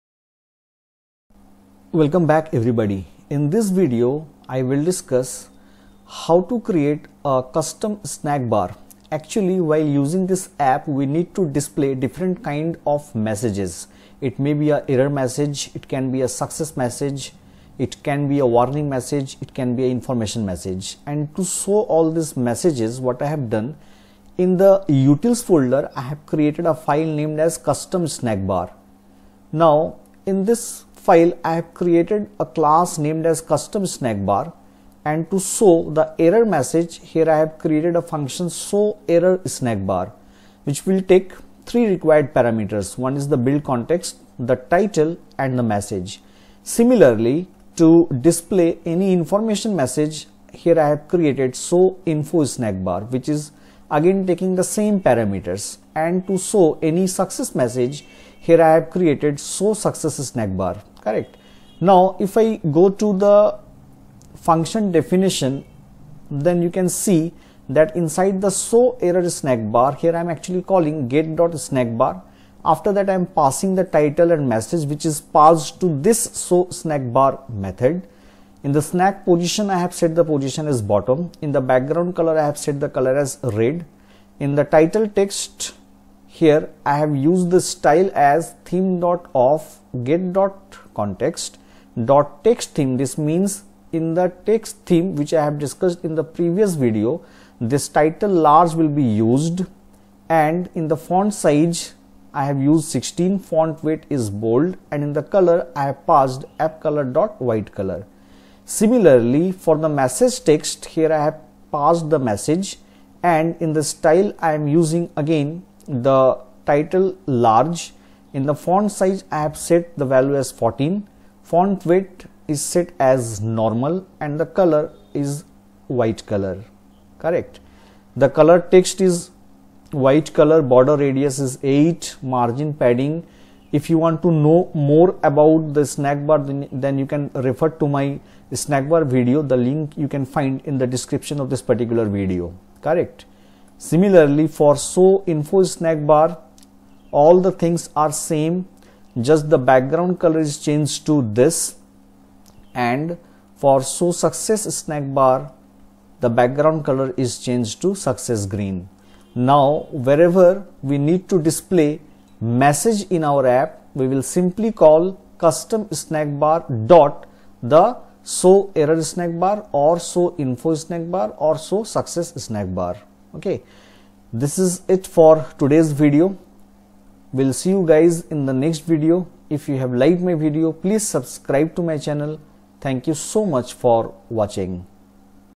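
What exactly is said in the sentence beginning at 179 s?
If you have liked my video, please subscribe to my channel.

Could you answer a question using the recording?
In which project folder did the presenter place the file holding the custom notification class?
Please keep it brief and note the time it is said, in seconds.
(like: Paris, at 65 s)
utils, at 24 s.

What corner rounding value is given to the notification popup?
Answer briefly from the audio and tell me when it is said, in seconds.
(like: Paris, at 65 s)
8, at 131 s.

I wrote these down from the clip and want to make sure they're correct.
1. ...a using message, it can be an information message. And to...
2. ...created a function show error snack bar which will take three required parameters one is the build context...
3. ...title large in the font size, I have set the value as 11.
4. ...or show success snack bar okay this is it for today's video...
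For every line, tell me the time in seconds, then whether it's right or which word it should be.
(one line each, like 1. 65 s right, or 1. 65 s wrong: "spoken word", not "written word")
1. 18 s wrong: "warning", not "using"
2. 37 s right
3. 116 s wrong: "14", not "11"
4. 171 s right.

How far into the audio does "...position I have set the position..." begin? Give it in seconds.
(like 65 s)
79 s.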